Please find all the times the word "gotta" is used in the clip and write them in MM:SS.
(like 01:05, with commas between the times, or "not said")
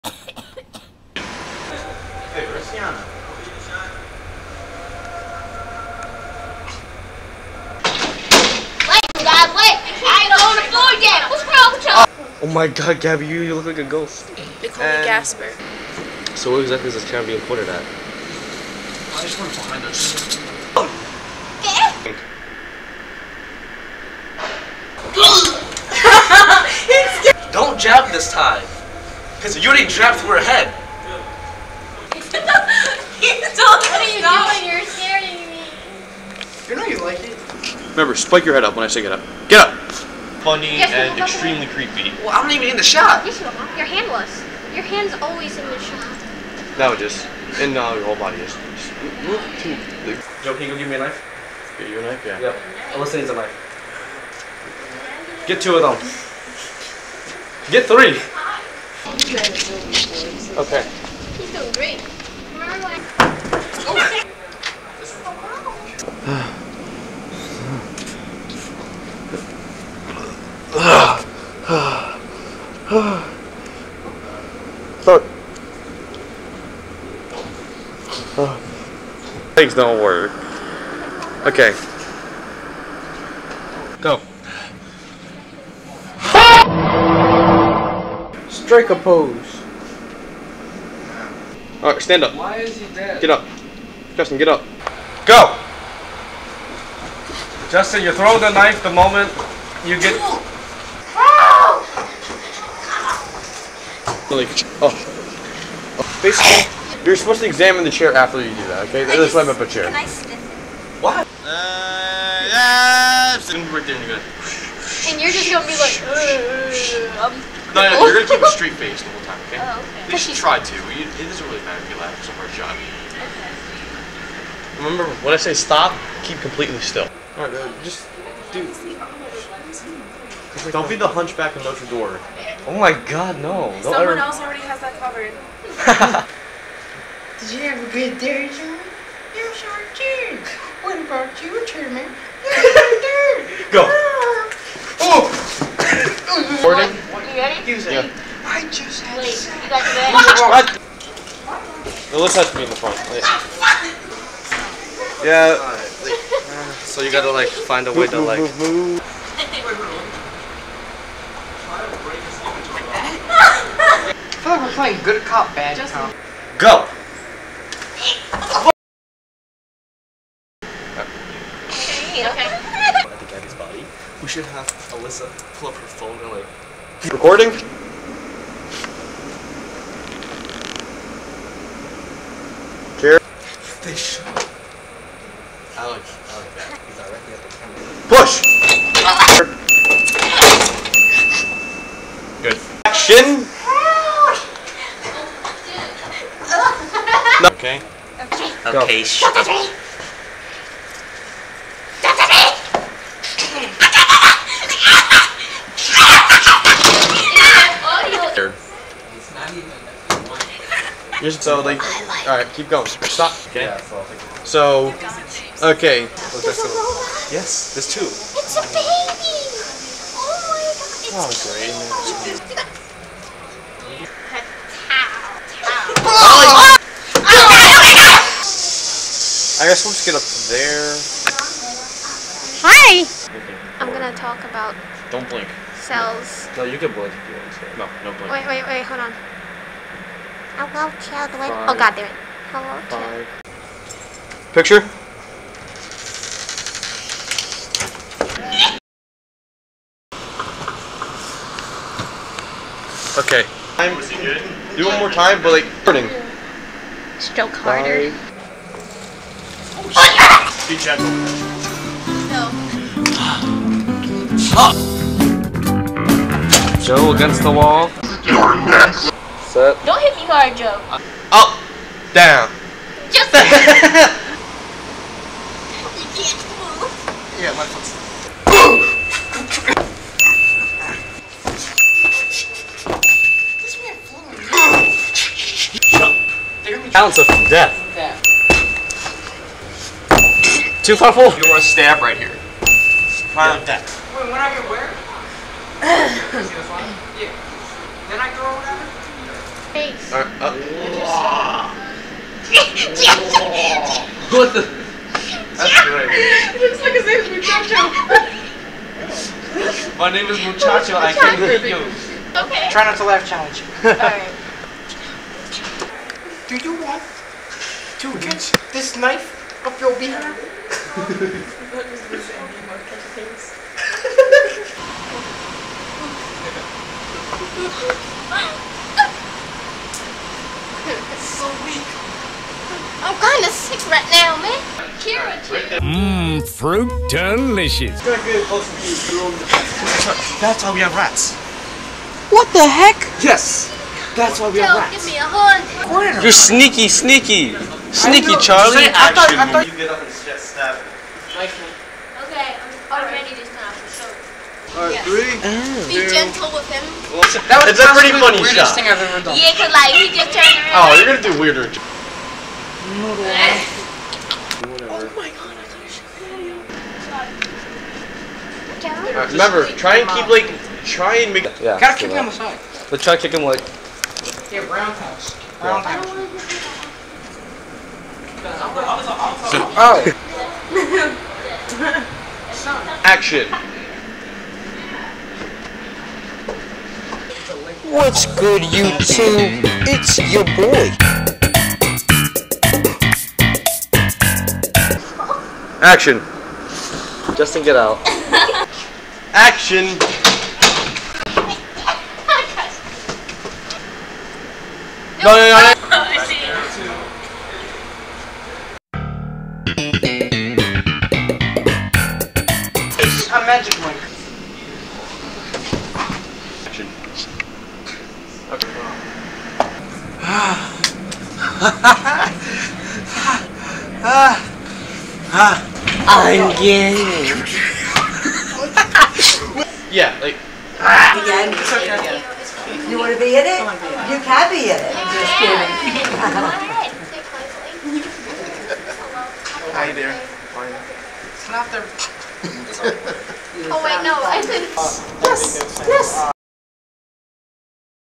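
02:37, 06:11.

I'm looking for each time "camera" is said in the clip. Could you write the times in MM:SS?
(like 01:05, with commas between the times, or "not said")
00:17, 03:12.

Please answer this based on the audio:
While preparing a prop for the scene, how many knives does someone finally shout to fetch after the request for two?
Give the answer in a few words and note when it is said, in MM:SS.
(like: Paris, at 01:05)
3, at 00:57.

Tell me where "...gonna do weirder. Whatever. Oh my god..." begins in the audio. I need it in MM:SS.
06:01.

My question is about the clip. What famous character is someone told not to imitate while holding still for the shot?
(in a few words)
the hunchback of Notre Dame.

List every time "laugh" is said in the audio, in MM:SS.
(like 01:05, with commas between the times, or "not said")
02:01, 05:13.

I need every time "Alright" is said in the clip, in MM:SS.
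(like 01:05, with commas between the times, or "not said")
01:31, 02:07, 05:00, 05:13, 05:54.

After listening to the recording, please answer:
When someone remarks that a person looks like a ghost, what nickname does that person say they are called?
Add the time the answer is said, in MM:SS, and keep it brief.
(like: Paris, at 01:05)
Gasper, at 00:15.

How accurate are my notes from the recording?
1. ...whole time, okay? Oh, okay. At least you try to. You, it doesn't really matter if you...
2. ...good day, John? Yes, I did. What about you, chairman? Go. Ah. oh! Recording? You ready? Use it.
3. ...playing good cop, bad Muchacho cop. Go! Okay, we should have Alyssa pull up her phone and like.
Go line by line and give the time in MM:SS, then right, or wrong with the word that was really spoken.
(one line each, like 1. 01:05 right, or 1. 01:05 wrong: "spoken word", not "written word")
1. 01:59 right
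2. 02:17 right
3. 02:44 wrong: "Just", not "Muchacho".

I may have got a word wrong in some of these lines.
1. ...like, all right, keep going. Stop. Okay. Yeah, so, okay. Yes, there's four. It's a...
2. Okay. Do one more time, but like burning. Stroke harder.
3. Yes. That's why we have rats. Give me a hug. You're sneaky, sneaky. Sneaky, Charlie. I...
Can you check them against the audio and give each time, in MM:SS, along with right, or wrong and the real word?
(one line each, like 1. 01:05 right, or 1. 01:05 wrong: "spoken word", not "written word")
1. 03:31 wrong: "two", not "four"
2. 04:13 right
3. 05:43 right.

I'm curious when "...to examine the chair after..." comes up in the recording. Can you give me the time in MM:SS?
01:47.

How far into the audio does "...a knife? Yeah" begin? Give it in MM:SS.
00:51.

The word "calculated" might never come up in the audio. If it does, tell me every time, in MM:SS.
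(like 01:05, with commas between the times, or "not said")
not said.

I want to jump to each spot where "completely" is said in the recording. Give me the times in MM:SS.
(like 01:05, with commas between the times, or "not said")
02:06.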